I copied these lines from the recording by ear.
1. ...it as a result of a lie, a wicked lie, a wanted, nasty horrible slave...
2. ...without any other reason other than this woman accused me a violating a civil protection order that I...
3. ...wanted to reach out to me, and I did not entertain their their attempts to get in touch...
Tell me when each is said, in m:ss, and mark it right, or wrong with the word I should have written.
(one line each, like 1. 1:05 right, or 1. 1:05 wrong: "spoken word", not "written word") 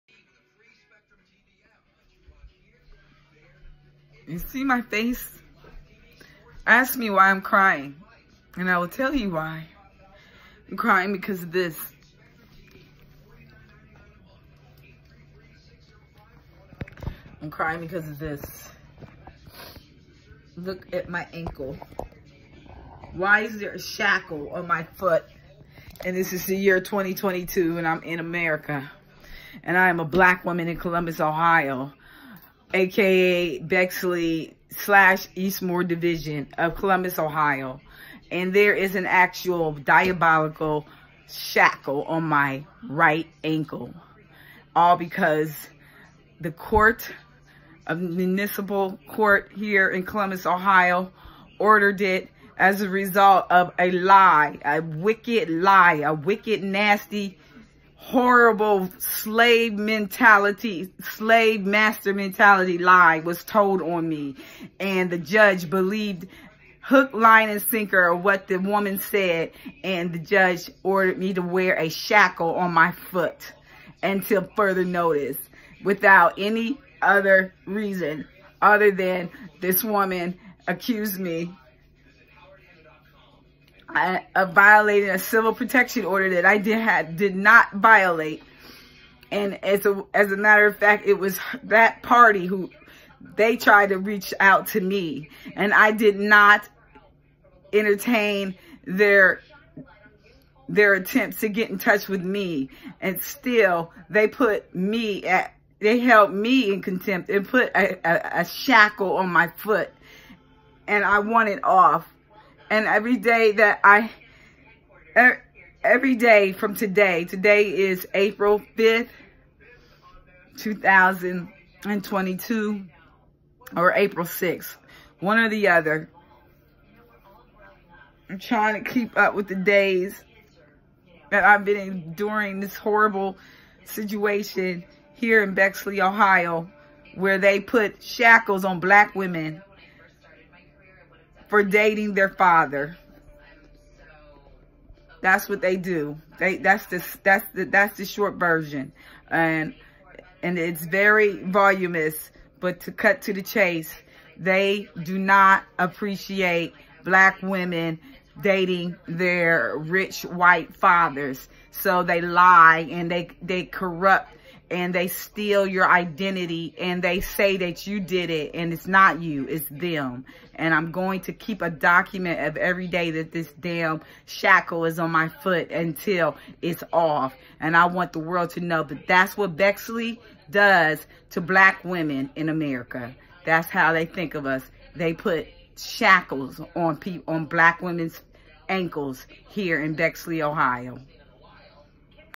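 1. 0:51 wrong: "wicked", not "wanted"
2. 1:15 right
3. 1:33 wrong: "tried", not "wanted".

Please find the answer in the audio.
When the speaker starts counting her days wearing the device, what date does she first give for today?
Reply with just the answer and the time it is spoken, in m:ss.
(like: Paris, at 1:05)
April 5th, at 1:58.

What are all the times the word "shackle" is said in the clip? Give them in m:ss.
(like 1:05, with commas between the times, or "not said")
0:23, 0:41, 1:11, 1:48, 2:18, 2:54, 3:05.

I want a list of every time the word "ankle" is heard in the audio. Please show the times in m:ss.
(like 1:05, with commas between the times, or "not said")
0:21, 0:43, 3:08.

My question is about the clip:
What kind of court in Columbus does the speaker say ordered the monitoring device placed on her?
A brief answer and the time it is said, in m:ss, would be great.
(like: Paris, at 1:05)
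Municipal court, at 0:47.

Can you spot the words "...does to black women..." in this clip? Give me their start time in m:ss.
3:00.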